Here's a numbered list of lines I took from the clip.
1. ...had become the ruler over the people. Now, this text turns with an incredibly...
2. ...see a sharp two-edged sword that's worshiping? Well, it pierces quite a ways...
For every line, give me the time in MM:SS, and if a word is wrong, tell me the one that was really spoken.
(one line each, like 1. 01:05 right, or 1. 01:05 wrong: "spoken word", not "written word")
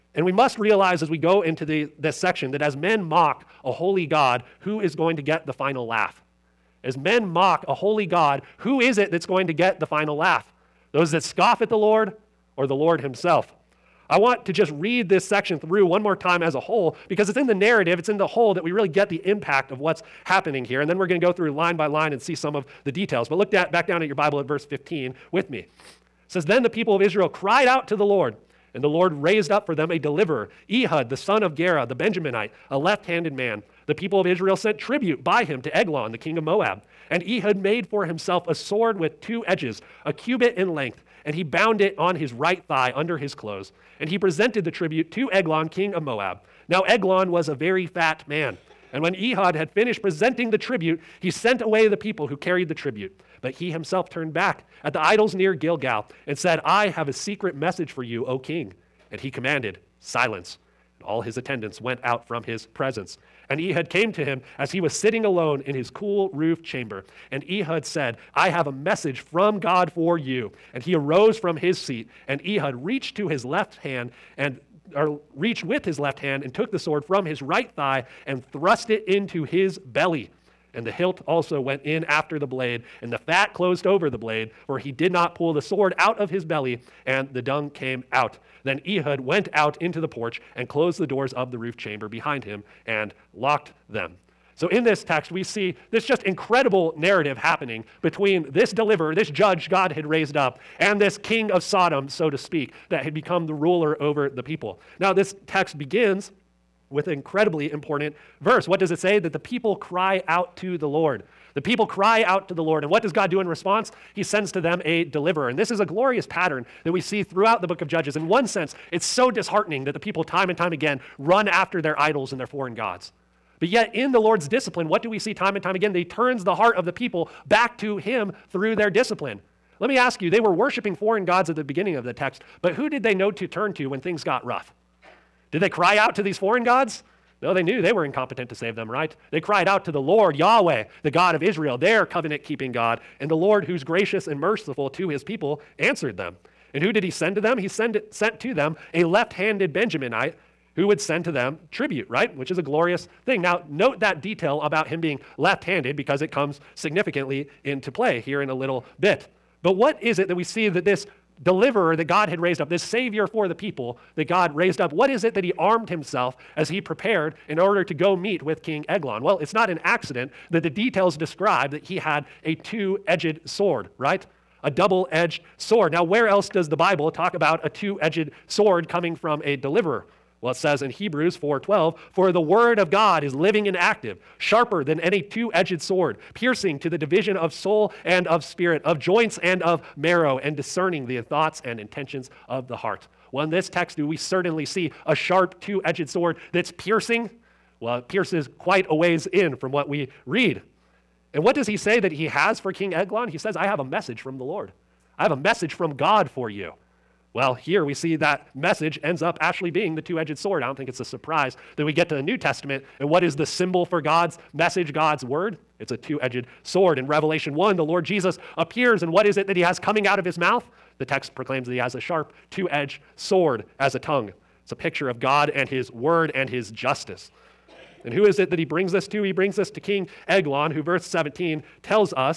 1. 01:43 wrong: "begins", not "turns"
2. 03:14 wrong: "piercing", not "worshiping".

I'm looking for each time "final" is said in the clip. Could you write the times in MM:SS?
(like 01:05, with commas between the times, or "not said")
00:05, 00:09.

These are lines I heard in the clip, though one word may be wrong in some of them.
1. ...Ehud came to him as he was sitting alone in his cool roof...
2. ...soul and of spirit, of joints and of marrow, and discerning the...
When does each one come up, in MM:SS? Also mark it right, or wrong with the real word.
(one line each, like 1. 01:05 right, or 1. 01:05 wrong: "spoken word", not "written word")
1. 01:03 right
2. 03:07 right.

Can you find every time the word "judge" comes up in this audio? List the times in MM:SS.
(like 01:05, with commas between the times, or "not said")
01:39, 01:57.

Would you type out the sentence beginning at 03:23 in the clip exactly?
He says, I have a message from the Lord.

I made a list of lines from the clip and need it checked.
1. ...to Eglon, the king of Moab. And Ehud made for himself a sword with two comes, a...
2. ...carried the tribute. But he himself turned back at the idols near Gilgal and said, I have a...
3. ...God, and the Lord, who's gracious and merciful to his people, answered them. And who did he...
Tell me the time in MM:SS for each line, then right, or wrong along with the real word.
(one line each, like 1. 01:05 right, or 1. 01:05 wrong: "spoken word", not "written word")
1. 00:35 wrong: "edges", not "comes"
2. 00:52 right
3. 02:22 right.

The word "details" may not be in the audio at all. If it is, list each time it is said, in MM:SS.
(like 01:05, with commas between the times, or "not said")
00:22, 02:34, 02:50.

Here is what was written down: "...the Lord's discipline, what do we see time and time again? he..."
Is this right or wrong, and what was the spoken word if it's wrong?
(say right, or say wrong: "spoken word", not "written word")
right.